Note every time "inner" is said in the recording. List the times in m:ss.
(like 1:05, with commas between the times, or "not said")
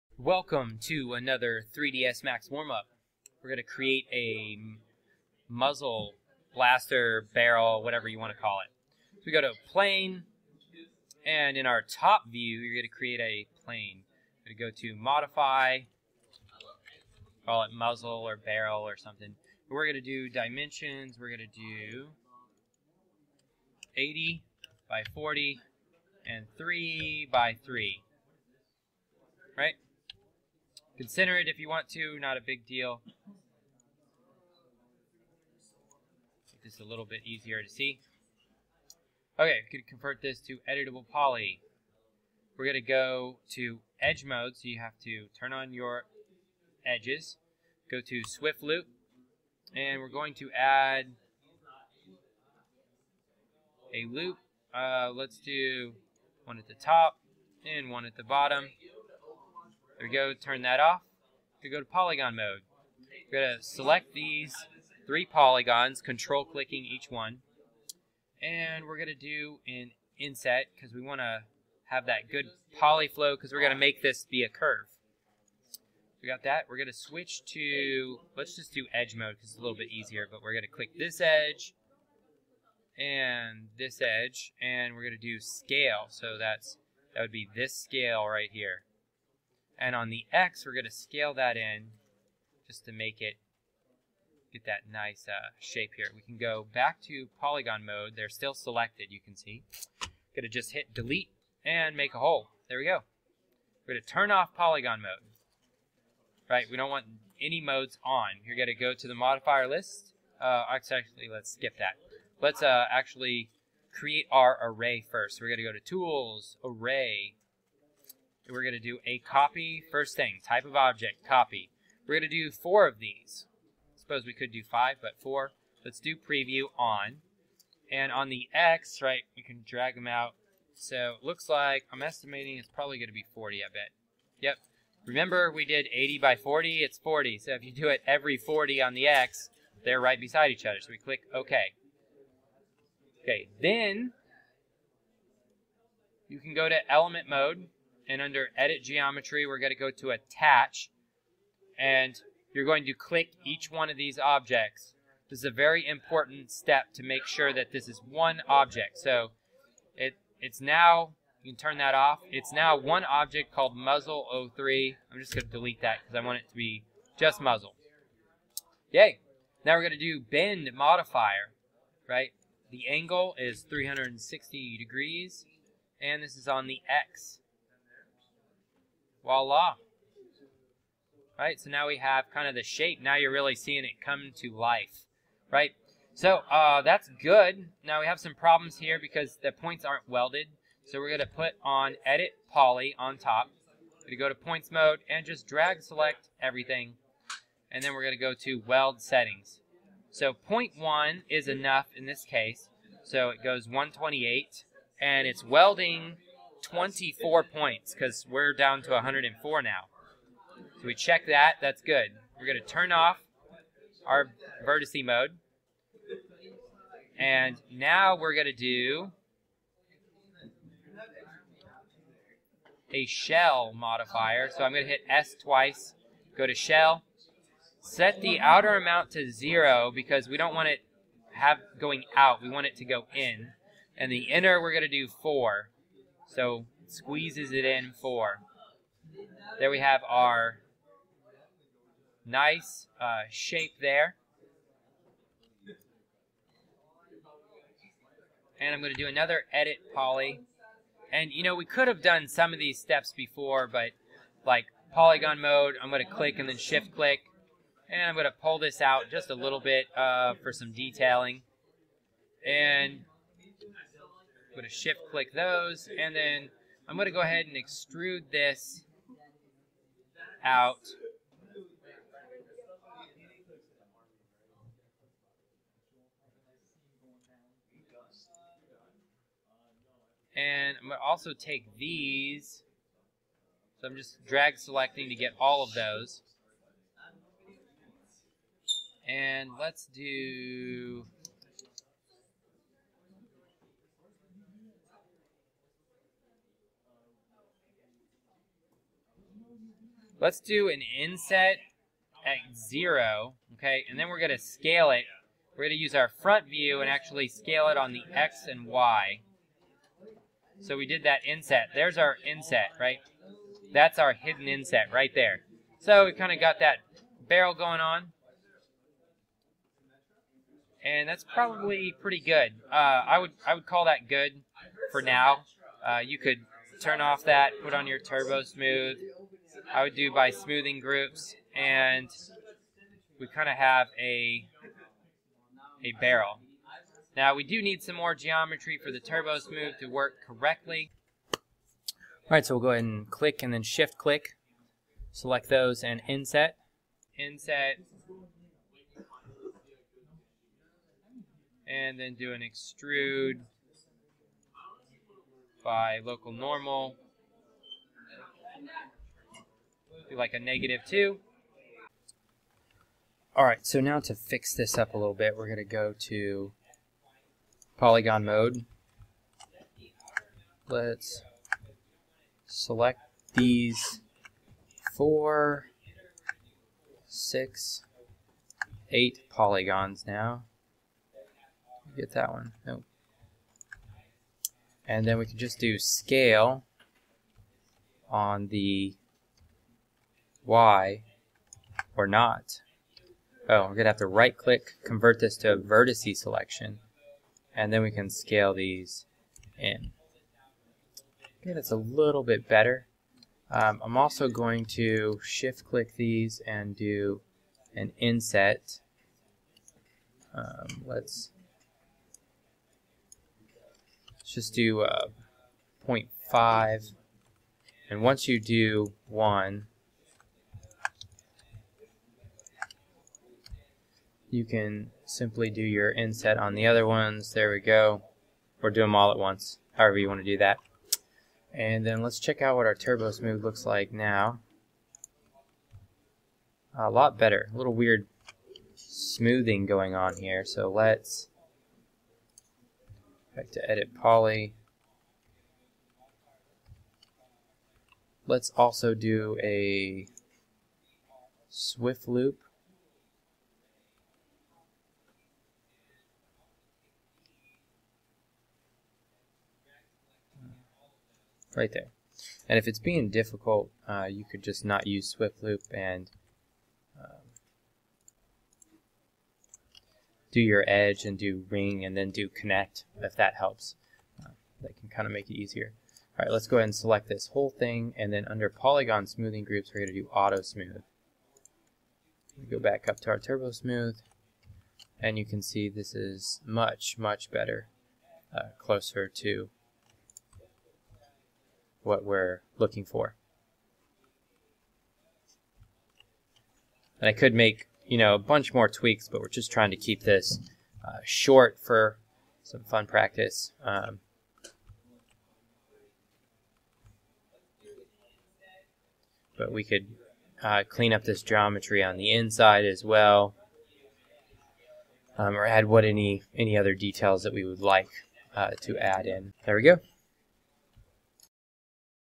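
3:54.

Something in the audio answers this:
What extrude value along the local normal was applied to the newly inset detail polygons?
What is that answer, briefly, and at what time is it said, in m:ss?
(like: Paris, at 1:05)
-2, at 6:00.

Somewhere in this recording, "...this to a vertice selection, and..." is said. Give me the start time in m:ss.
6:35.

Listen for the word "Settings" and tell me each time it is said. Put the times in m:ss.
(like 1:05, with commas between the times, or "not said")
3:19.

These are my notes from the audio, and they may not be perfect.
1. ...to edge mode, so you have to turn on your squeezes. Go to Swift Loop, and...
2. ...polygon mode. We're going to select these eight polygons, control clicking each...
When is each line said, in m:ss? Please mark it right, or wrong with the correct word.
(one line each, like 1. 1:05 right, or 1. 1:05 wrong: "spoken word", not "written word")
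1. 0:43 wrong: "edges", not "squeezes"
2. 1:01 wrong: "three", not "eight".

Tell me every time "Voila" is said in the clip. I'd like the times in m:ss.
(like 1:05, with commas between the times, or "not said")
2:59.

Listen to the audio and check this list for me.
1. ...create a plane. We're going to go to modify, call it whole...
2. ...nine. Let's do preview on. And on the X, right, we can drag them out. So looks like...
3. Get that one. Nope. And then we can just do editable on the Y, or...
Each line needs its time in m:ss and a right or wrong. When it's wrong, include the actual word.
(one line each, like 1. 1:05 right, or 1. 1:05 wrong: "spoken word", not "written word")
1. 0:12 wrong: "muzzle", not "whole"
2. 2:05 wrong: "four", not "nine"
3. 6:21 wrong: "scale", not "editable".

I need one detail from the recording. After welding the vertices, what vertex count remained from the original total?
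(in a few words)
104.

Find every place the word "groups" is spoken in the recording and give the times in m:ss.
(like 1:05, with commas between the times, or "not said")
5:30, 7:59.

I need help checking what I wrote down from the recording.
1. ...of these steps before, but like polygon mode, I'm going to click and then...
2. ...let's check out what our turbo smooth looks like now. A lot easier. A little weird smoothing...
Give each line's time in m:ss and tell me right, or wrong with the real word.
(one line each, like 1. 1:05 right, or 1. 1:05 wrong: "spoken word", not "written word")
1. 4:12 right
2. 7:12 wrong: "better", not "easier".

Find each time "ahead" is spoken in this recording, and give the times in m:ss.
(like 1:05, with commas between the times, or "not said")
4:27, 5:42, 7:56.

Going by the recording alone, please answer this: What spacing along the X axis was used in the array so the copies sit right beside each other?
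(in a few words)
40.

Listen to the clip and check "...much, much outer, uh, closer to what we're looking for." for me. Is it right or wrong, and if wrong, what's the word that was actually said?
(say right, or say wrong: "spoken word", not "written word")
wrong: "better", not "outer".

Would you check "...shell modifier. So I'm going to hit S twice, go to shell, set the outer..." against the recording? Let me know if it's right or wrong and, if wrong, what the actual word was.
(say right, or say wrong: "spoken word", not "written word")
right.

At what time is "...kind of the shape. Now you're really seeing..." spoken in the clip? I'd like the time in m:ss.
3:02.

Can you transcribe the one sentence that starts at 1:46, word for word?
Right, we don't want any modes on.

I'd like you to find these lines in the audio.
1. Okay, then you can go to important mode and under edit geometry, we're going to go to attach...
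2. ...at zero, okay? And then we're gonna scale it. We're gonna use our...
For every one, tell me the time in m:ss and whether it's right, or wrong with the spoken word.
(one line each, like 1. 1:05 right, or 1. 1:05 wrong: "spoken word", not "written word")
1. 2:23 wrong: "element", not "important"
2. 5:02 right.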